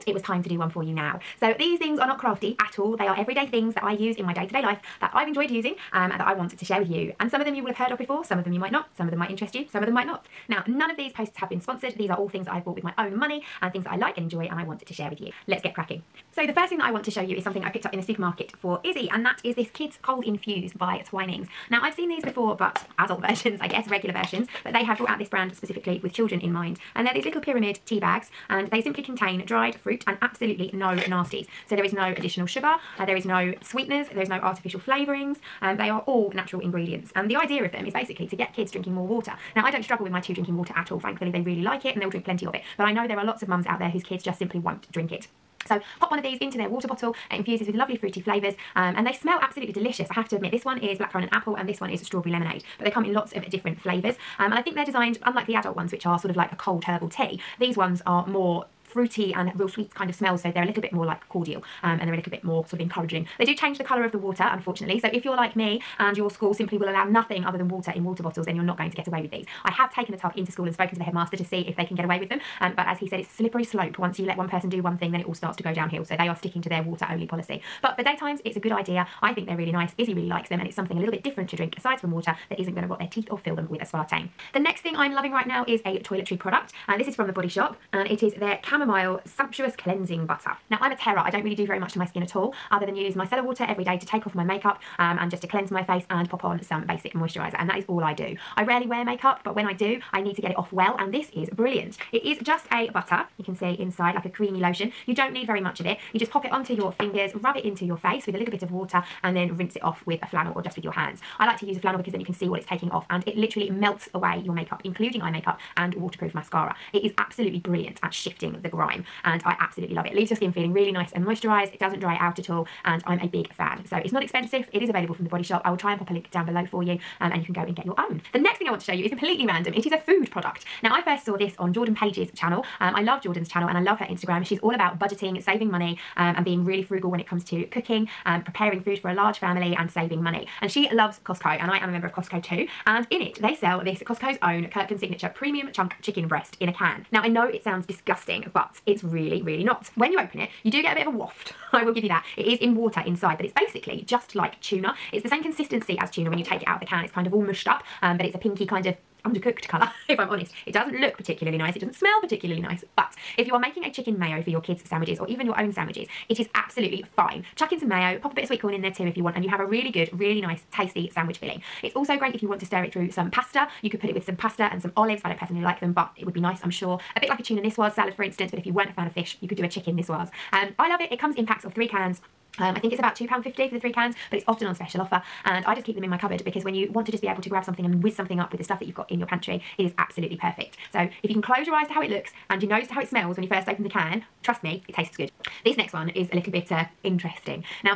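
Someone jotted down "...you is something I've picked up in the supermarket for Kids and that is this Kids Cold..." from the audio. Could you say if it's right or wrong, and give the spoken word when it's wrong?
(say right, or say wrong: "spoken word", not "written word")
wrong: "Izzy", not "Kids".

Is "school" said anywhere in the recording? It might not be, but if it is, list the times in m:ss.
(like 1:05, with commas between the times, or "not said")
1:06, 1:10.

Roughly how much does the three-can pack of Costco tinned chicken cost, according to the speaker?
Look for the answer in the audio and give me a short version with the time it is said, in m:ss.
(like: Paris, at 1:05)
£2.50, at 3:03.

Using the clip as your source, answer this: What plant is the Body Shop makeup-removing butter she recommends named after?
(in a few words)
Chamomile.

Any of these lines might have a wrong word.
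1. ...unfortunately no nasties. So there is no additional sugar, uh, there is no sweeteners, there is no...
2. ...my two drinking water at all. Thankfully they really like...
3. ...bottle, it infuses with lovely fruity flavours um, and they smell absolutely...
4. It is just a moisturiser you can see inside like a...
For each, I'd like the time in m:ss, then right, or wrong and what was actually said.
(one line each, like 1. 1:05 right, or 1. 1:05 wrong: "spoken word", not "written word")
1. 0:30 wrong: "absolutely", not "unfortunately"
2. 0:40 right
3. 0:46 right
4. 1:42 wrong: "butter", not "moisturiser".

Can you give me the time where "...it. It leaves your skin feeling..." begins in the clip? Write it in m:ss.
2:00.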